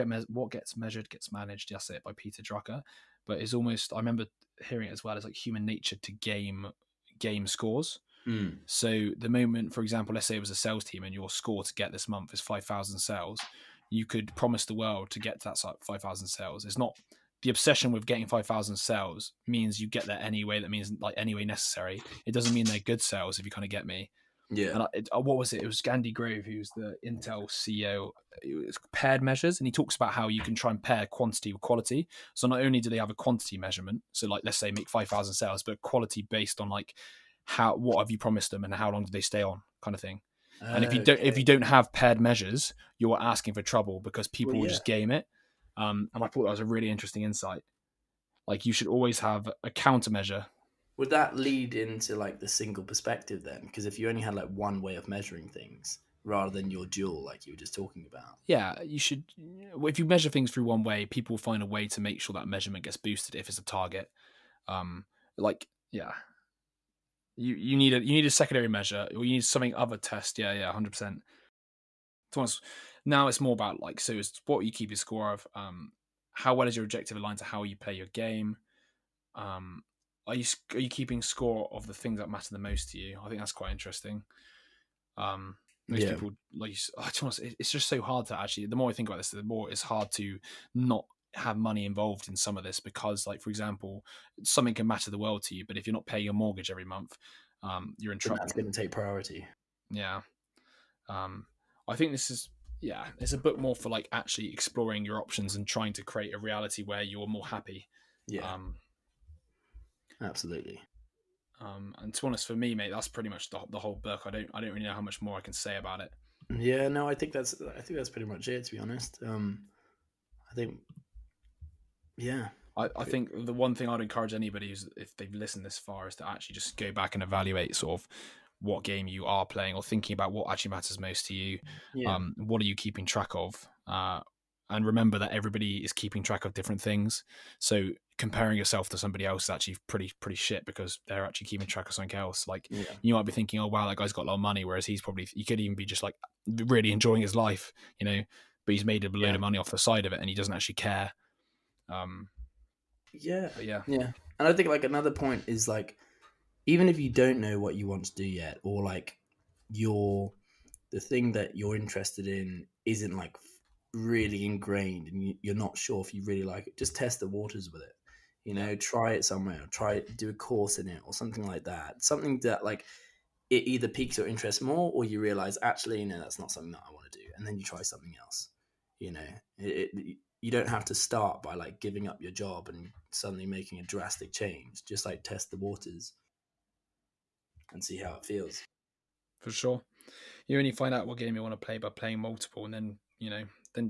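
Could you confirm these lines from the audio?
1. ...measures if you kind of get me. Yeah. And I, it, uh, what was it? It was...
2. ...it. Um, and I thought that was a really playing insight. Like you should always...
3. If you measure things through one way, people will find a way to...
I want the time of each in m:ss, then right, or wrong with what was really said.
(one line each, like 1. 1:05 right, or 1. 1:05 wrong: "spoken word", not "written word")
1. 0:23 wrong: "sales", not "measures"
2. 0:45 wrong: "interesting", not "playing"
3. 0:59 right.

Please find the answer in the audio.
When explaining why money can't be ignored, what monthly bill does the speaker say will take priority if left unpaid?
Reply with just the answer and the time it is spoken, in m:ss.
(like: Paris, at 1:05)
mortgage, at 1:36.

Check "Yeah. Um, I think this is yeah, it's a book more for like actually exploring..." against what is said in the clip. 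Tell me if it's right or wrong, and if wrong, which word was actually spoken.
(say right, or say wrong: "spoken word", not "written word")
right.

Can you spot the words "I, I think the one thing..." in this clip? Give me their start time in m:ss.
2:02.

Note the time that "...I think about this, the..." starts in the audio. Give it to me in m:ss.
1:28.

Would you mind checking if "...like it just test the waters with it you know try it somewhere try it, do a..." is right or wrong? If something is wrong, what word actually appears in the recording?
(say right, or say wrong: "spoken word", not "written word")
right.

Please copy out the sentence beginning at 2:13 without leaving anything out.
Uh, and remember that everybody is keeping track of different things.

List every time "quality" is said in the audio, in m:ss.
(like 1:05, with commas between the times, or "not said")
0:31, 0:35.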